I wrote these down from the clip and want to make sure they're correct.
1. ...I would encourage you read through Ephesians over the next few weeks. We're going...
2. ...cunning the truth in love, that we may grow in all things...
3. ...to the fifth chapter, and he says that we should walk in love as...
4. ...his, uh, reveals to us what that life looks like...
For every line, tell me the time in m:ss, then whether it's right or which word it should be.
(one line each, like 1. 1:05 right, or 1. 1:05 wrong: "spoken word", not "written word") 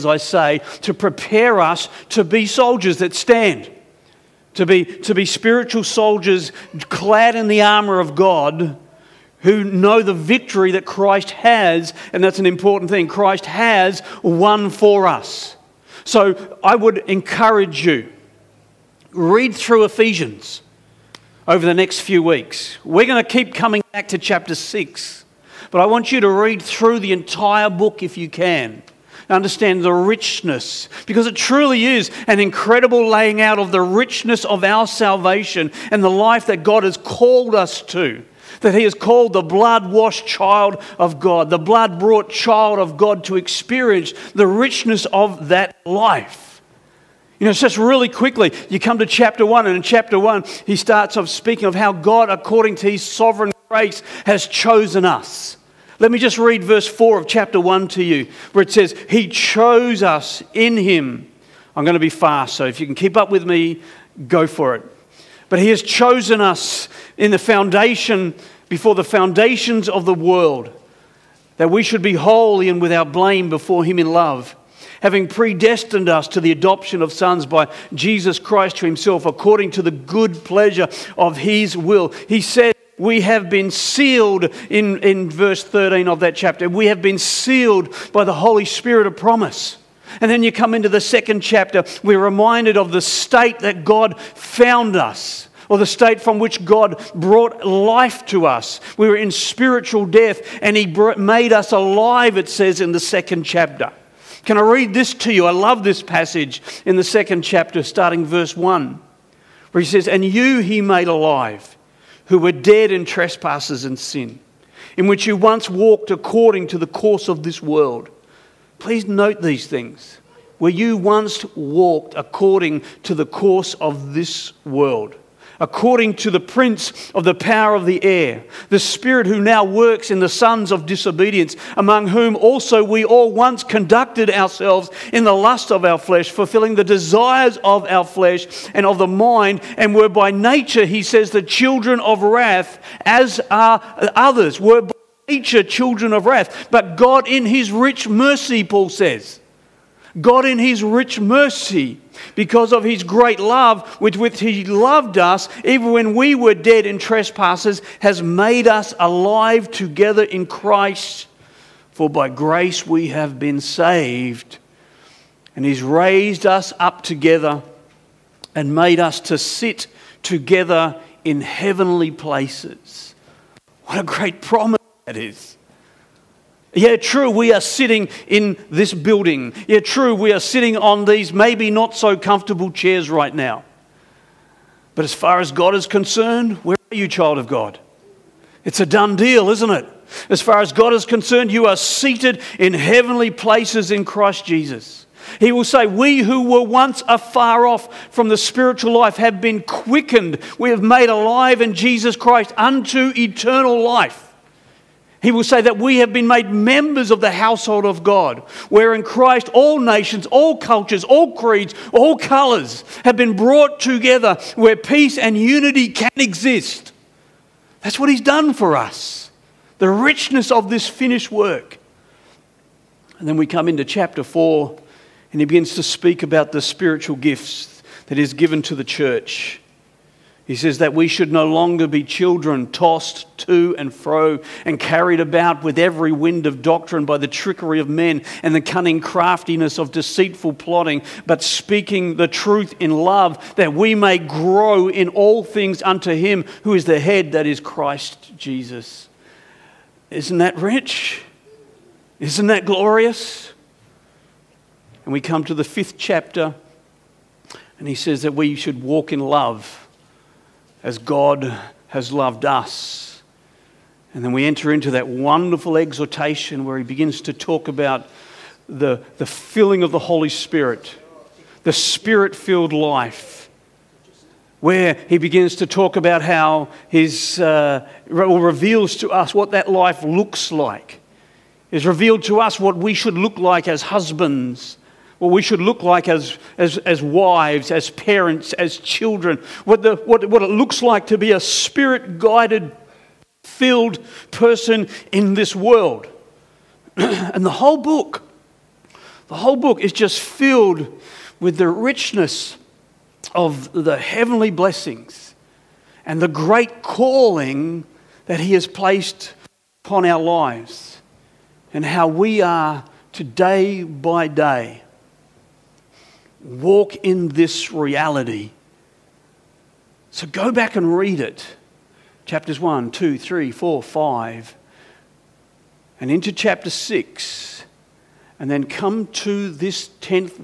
1. 0:16 right
2. 4:01 wrong: "speaking", not "cunning"
3. 4:15 right
4. 4:36 right.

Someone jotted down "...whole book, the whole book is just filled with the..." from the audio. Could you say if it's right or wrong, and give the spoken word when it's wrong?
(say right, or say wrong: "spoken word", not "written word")
right.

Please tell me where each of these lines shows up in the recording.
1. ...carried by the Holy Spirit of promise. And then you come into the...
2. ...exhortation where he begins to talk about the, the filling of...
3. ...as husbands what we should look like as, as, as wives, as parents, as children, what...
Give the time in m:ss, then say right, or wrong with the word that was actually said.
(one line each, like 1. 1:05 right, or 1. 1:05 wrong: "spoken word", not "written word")
1. 1:27 wrong: "sealed", not "carried"
2. 4:25 right
3. 4:43 right.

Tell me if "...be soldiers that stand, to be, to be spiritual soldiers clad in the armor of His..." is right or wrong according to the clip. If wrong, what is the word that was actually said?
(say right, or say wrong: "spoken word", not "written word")
wrong: "God", not "His".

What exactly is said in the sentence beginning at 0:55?
Let me just read verse 4 of chapter 1 to you, where it says, He chose us in Him.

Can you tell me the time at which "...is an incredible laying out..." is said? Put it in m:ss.
0:31.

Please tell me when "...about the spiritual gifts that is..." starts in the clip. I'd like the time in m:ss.
3:46.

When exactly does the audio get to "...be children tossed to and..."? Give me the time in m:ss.
3:51.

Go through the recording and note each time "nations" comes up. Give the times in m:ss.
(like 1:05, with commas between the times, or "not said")
3:29.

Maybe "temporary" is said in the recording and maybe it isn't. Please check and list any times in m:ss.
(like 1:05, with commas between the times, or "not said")
not said.